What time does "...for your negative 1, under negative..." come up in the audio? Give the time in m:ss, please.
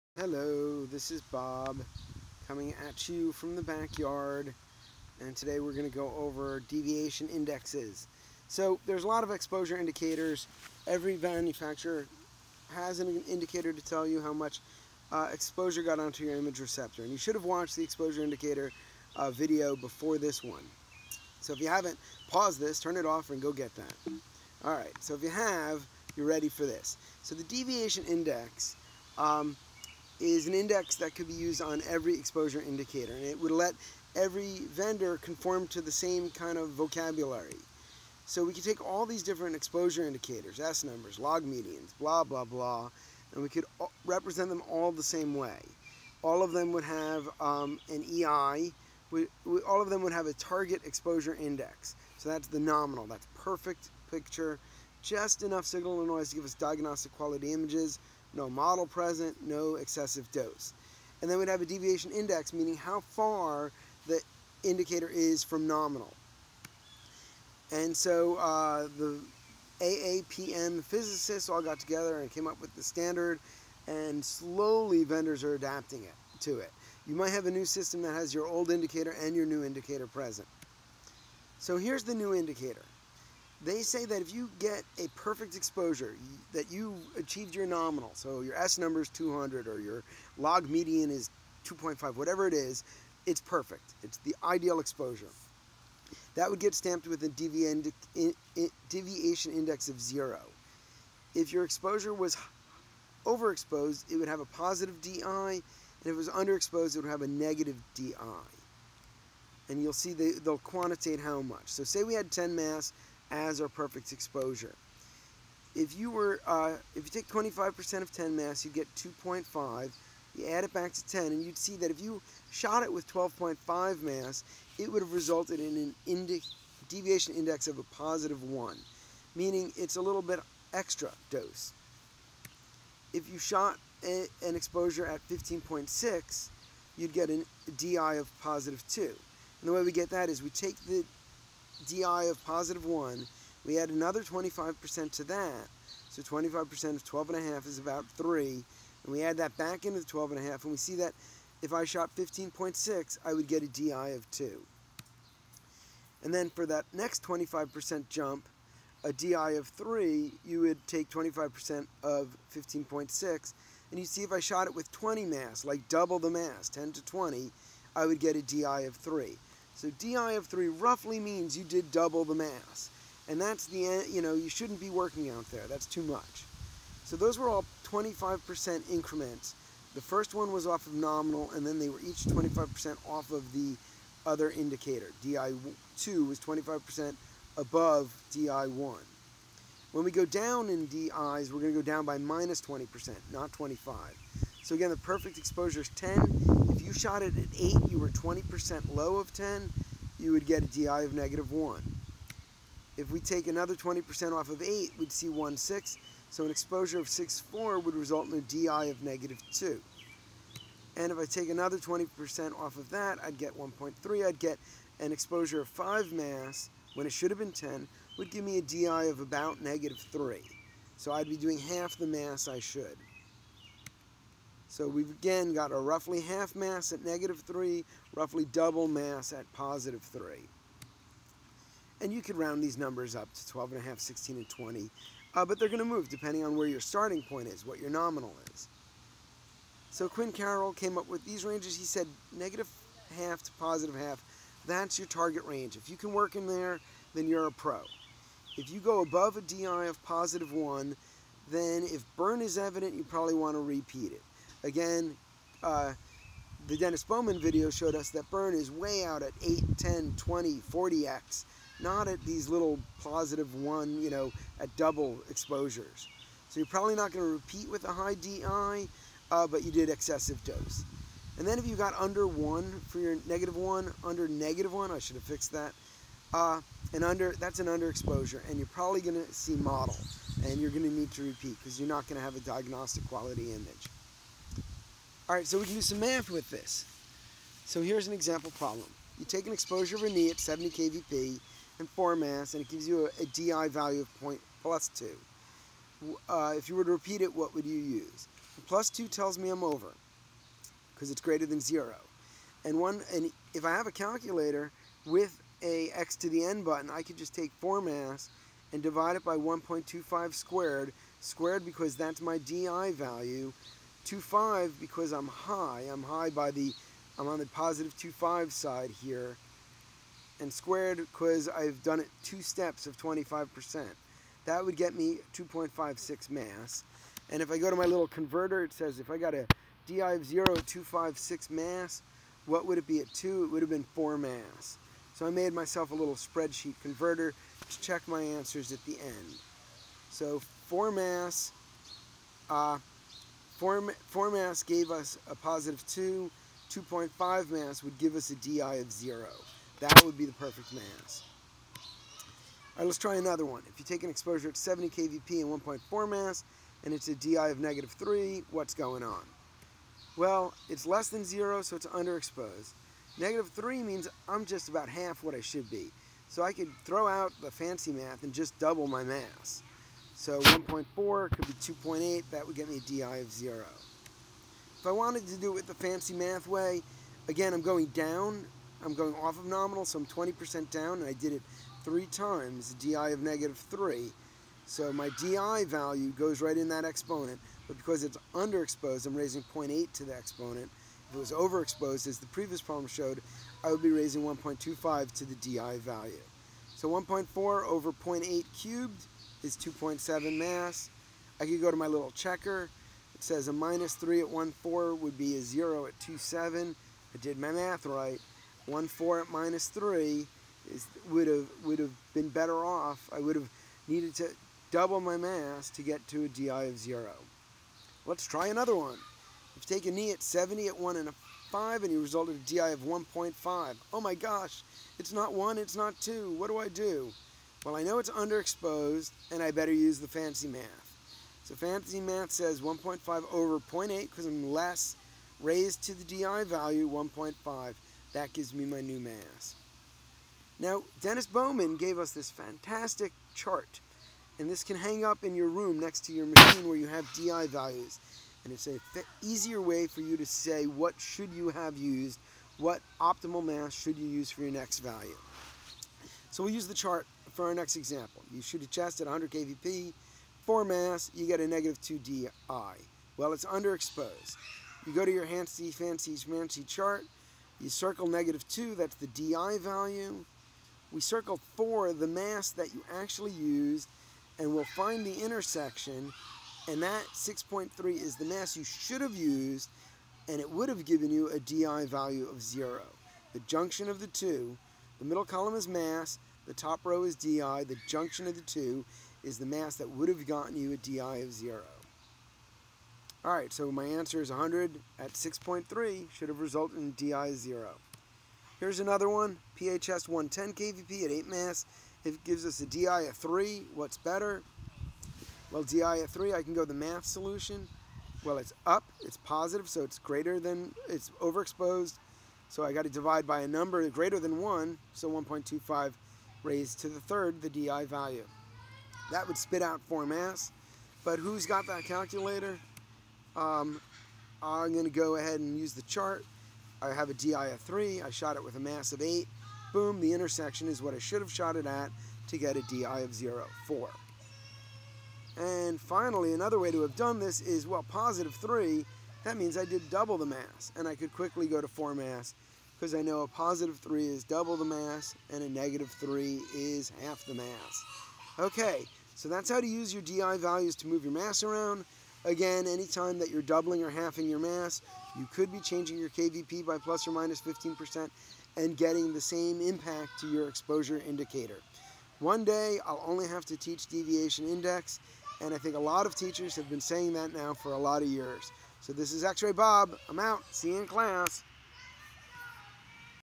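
4:32.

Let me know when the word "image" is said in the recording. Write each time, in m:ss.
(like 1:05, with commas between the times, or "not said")
0:16, 0:57, 4:43.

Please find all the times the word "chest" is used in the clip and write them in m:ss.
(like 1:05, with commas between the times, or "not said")
7:38.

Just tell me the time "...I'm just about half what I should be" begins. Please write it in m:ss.
6:04.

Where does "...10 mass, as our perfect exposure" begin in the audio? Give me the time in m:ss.
1:52.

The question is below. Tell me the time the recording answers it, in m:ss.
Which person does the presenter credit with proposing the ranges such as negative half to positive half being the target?
4:00.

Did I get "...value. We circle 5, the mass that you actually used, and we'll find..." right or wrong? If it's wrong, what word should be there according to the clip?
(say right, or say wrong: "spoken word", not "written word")
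wrong: "4", not "5".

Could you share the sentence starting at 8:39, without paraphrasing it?
That would spit out 4 mass, but who's got that calculator?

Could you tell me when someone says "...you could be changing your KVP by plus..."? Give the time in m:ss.
9:15.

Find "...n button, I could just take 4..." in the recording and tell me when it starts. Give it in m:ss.
5:06.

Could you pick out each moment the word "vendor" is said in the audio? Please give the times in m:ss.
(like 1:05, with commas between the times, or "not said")
0:34, 1:15.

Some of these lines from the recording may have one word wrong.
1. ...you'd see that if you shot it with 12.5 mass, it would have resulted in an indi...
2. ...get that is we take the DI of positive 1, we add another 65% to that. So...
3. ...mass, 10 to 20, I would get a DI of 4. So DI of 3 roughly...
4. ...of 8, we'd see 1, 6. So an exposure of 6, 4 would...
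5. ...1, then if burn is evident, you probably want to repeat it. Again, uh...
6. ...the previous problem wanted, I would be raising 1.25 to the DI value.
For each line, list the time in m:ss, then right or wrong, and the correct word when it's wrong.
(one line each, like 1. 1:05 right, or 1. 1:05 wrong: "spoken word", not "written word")
1. 2:01 right
2. 2:19 wrong: "25", not "65"
3. 2:46 wrong: "3", not "4"
4. 3:24 right
5. 4:10 right
6. 6:32 wrong: "showed", not "wanted".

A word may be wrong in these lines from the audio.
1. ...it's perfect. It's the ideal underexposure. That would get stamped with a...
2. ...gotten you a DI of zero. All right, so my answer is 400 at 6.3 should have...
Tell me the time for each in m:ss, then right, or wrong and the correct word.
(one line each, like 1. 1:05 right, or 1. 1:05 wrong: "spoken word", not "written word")
1. 1:33 wrong: "exposure", not "underexposure"
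2. 8:10 wrong: "100", not "400".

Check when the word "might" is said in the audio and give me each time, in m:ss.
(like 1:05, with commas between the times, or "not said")
1:17.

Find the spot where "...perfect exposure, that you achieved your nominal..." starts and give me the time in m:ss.
1:25.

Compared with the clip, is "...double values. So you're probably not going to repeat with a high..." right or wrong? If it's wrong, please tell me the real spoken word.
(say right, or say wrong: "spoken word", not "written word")
wrong: "exposures", not "values".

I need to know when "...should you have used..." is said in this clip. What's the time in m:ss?
7:30.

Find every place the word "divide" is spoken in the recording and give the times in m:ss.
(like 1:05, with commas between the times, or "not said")
5:08, 8:32.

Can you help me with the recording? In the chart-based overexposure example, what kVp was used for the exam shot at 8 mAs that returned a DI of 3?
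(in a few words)
110 kVp.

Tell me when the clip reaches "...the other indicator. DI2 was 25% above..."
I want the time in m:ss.
3:03.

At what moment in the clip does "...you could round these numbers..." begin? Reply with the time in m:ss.
3:52.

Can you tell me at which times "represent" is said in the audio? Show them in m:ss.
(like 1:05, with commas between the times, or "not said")
0:44.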